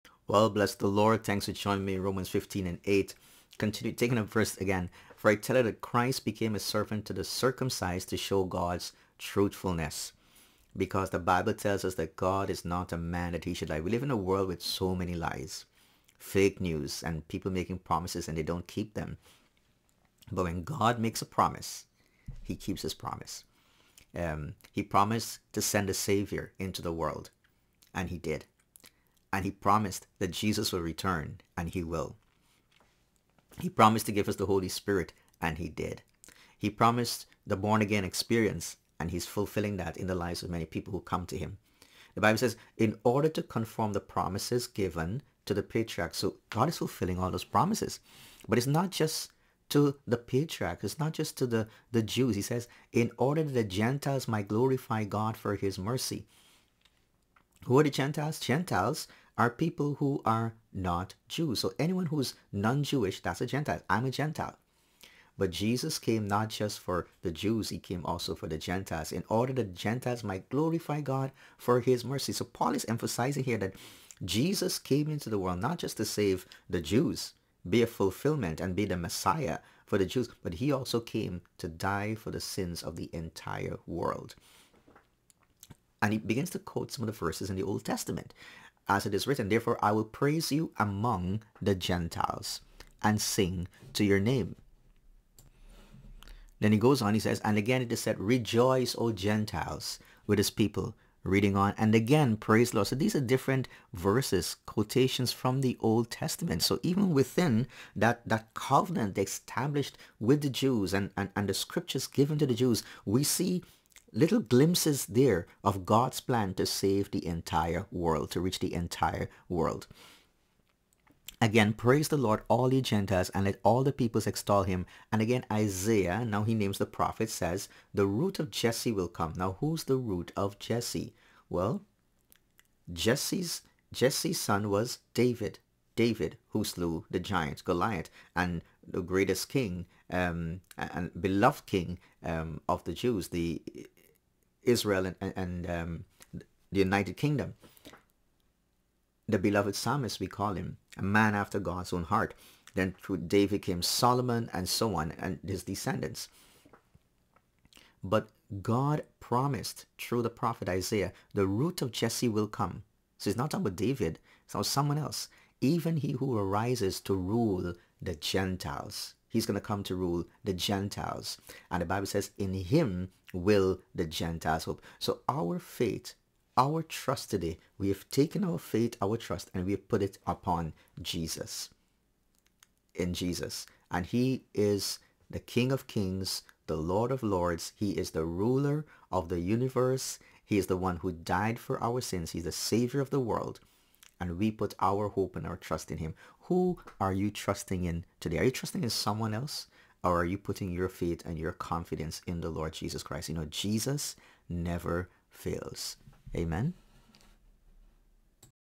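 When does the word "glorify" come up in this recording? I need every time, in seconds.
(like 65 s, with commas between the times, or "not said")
54 s, 70 s.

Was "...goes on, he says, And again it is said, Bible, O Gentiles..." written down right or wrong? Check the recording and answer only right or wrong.
wrong.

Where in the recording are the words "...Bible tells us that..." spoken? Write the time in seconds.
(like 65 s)
11 s.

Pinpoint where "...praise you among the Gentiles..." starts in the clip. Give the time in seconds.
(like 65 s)
90 s.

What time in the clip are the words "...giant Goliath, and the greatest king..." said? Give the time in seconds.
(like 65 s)
137 s.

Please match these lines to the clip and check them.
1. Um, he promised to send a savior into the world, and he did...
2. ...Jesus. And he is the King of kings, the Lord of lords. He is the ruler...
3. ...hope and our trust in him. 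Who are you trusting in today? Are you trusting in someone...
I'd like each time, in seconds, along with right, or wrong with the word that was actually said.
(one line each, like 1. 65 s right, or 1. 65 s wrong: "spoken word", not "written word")
1. 24 s right
2. 183 s right
3. 195 s right.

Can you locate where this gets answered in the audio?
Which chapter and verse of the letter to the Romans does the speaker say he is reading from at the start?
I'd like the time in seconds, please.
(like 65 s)
1 s.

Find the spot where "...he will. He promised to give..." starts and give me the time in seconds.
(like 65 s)
31 s.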